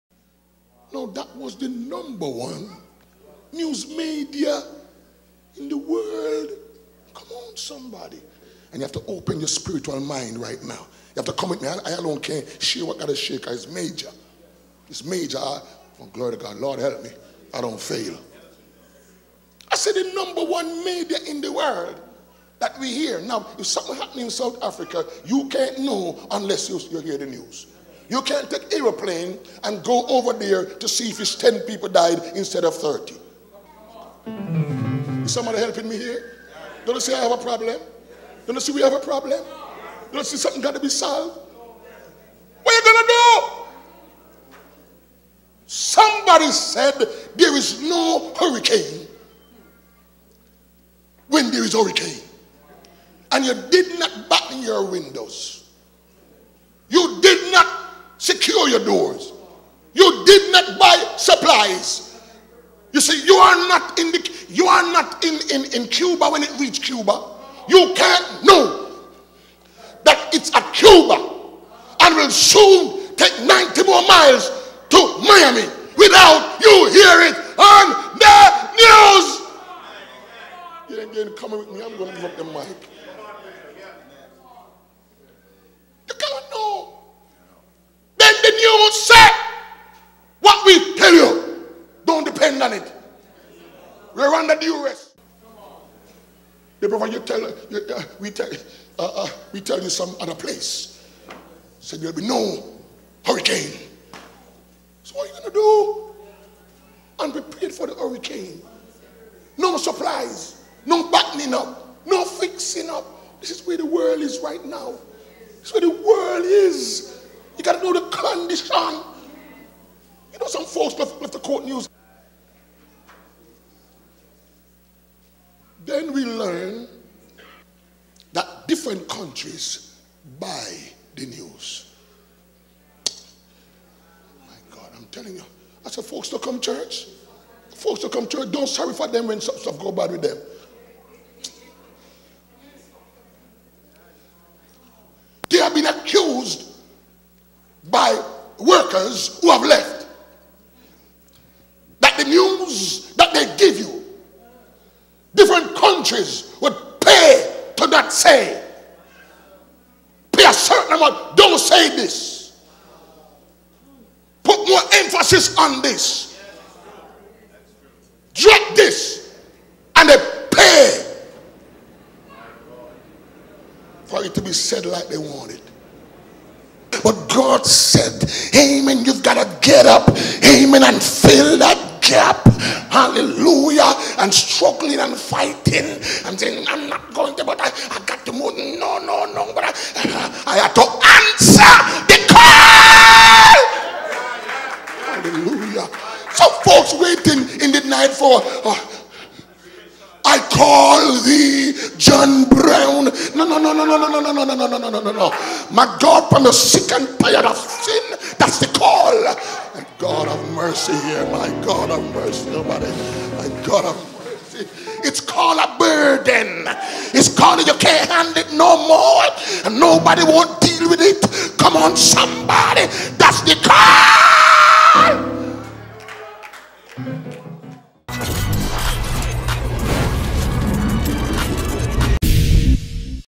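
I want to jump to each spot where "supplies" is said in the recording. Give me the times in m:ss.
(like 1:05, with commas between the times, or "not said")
1:01, 1:49.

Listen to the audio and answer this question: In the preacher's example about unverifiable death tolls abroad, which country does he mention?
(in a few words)
South Africa.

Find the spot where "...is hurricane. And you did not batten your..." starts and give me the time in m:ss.
0:51.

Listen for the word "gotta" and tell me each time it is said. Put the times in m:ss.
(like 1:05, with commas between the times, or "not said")
1:57.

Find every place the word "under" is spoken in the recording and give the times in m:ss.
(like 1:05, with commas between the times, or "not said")
1:34.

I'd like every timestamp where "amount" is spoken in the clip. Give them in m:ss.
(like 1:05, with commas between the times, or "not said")
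2:40.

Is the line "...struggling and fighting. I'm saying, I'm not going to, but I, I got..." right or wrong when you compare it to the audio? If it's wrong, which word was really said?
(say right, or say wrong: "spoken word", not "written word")
right.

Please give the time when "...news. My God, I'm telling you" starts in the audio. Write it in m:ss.
2:11.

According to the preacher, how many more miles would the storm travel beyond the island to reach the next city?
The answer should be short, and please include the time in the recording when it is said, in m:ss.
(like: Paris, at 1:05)
90, at 1:13.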